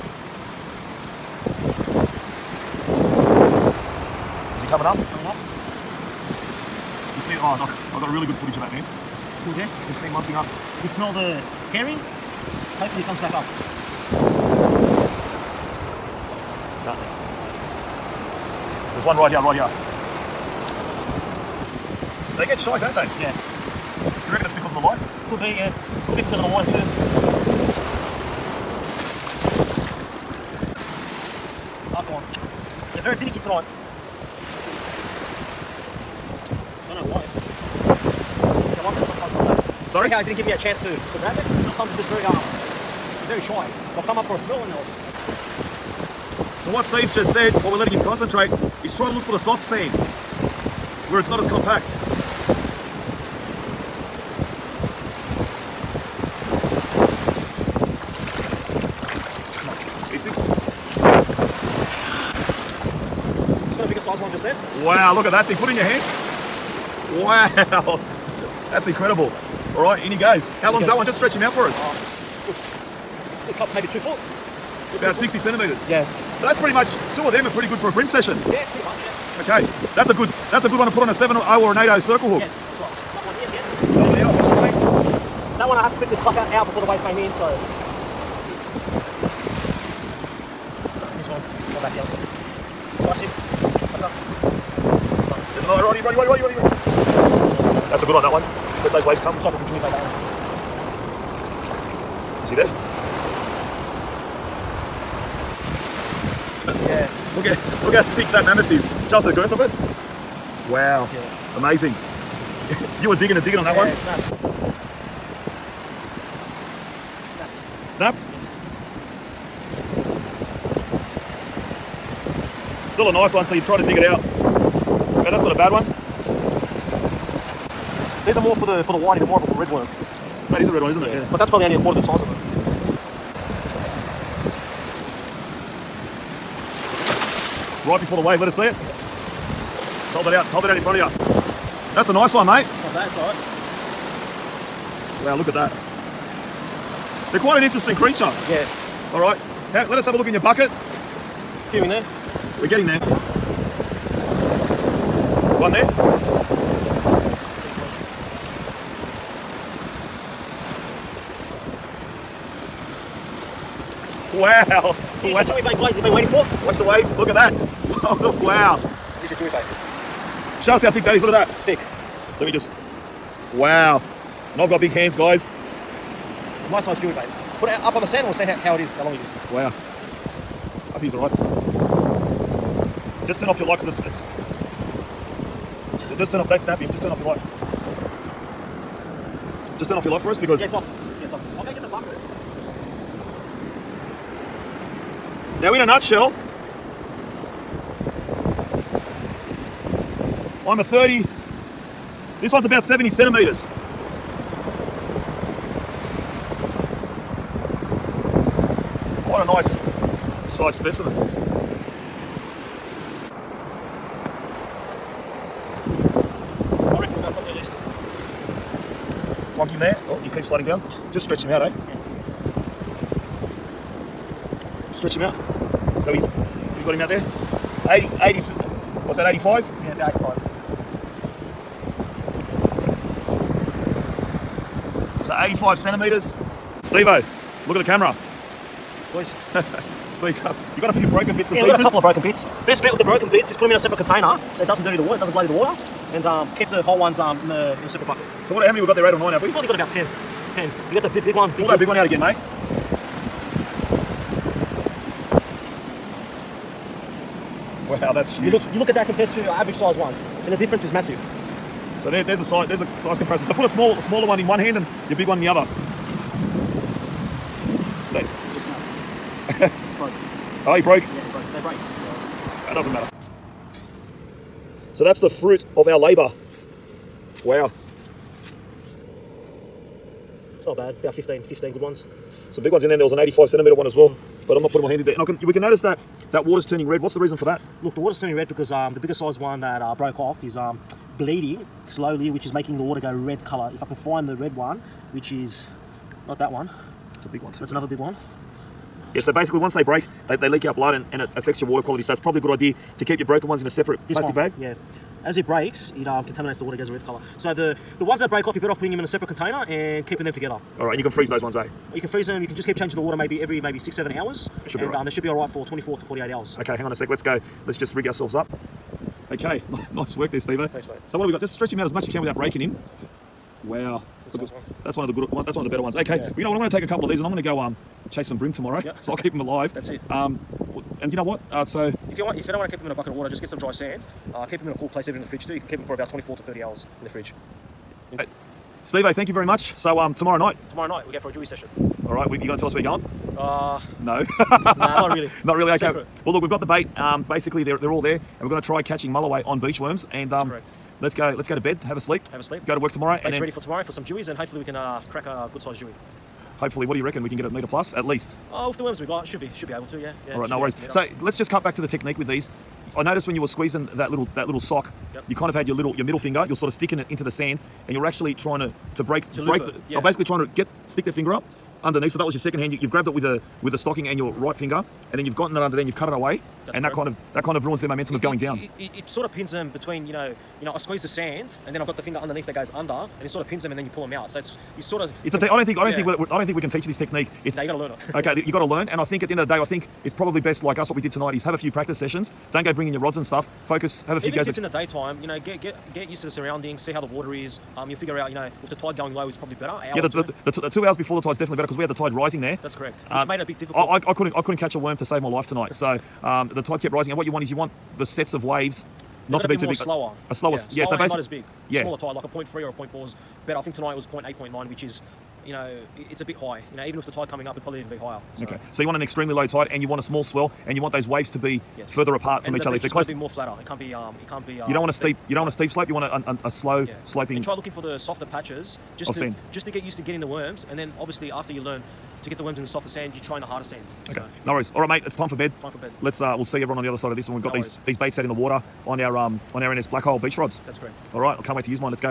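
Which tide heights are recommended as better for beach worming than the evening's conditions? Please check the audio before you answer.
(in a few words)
0.3 or 0.4.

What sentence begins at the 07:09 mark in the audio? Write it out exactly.
Just to get used to getting the worms.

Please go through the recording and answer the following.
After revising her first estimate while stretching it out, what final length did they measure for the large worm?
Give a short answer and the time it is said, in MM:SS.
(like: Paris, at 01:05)
85 centimetres, at 03:55.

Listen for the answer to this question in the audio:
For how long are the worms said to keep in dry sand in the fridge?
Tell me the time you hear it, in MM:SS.
05:36.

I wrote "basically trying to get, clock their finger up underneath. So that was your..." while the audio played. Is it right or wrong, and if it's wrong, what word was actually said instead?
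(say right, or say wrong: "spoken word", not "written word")
wrong: "stick", not "clock".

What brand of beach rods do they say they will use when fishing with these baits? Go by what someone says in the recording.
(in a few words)
NS Black Hole.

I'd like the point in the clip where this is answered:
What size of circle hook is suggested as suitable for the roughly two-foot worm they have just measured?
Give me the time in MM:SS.
01:21.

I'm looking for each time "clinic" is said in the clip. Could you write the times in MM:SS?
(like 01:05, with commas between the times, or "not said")
not said.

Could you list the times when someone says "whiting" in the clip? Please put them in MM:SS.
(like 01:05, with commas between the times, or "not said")
02:09.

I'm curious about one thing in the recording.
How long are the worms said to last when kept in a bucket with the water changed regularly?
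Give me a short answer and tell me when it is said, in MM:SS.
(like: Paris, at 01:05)
24 to 48 hours, at 05:15.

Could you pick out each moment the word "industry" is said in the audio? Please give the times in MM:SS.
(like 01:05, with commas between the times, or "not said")
not said.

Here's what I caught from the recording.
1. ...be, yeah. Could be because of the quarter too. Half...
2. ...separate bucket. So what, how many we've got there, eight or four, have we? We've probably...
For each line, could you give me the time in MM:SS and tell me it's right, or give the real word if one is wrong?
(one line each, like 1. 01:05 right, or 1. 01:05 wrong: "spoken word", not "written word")
1. 00:25 wrong: "water", not "quarter"
2. 04:07 wrong: "nine", not "four".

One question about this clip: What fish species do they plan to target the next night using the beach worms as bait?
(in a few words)
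mulloway.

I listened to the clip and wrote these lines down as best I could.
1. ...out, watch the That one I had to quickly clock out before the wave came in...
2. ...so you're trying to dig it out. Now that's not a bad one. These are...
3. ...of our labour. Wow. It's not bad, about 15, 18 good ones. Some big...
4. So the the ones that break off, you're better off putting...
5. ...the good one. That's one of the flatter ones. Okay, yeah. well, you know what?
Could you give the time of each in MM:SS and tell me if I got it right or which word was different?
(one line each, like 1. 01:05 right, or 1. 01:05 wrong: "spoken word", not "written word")
1. 01:24 right
2. 02:03 right
3. 04:35 wrong: "15", not "18"
4. 05:07 right
5. 05:25 wrong: "better", not "flatter".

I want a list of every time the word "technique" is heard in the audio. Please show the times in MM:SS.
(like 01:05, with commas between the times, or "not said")
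06:01, 06:26.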